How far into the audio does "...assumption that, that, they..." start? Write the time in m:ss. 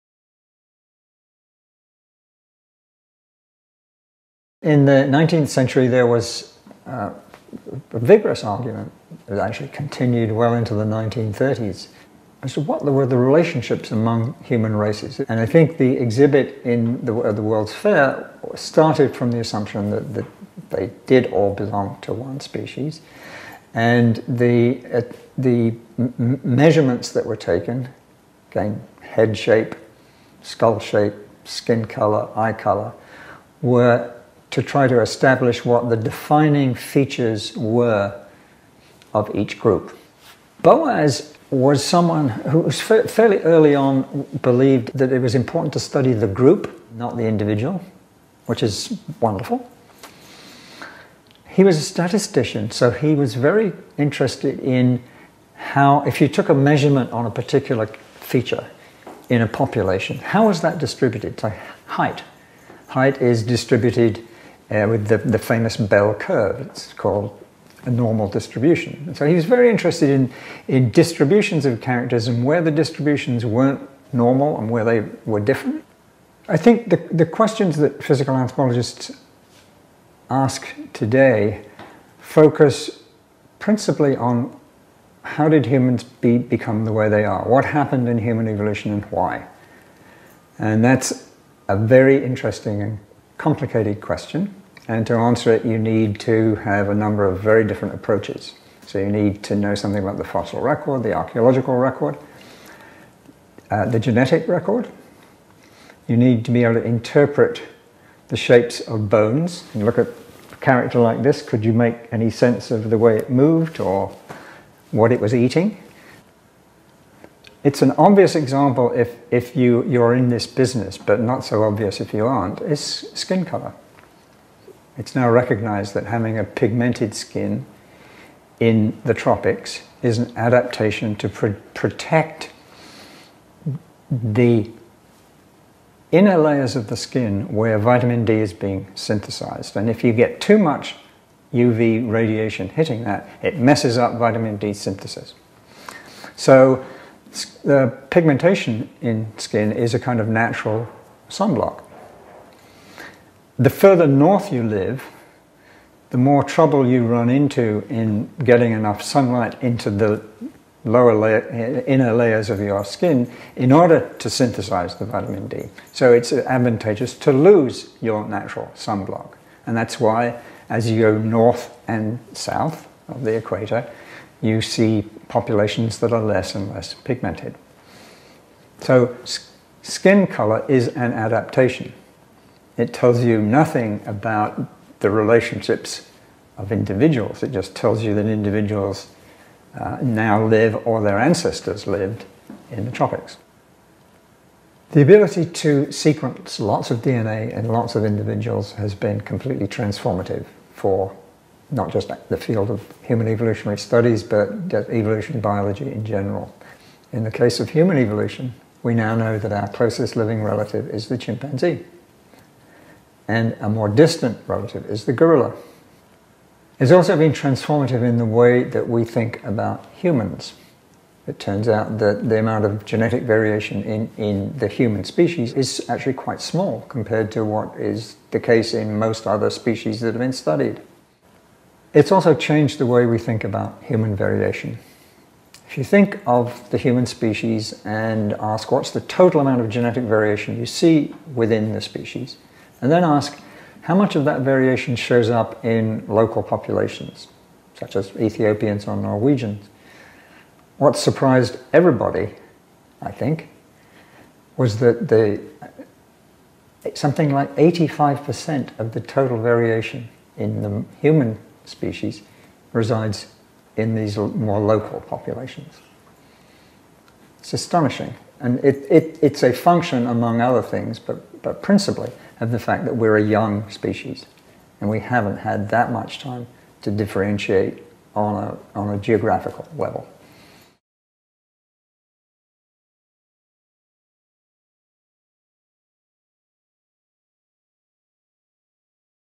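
0:19.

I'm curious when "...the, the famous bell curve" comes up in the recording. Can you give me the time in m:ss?
1:05.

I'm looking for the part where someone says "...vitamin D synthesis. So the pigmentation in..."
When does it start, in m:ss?
2:24.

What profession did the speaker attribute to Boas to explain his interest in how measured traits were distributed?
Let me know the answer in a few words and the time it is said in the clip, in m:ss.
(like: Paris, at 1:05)
Statistician, at 0:51.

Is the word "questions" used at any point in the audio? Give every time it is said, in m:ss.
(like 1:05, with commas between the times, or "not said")
1:17, 1:34.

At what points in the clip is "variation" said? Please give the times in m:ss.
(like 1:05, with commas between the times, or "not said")
3:43, 3:54, 4:00, 4:04, 4:19.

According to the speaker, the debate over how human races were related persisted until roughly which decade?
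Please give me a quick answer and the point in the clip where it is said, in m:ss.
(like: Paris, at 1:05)
1930s, at 0:10.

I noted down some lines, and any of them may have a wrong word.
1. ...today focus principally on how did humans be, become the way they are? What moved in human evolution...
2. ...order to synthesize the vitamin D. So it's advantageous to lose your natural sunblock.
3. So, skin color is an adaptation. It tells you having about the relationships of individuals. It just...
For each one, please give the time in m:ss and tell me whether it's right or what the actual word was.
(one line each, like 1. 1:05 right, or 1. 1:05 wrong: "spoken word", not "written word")
1. 1:20 wrong: "happened", not "moved"
2. 2:43 right
3. 2:58 wrong: "nothing", not "having".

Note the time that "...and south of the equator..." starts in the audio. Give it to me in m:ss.
2:51.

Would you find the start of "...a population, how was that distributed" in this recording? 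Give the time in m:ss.
0:59.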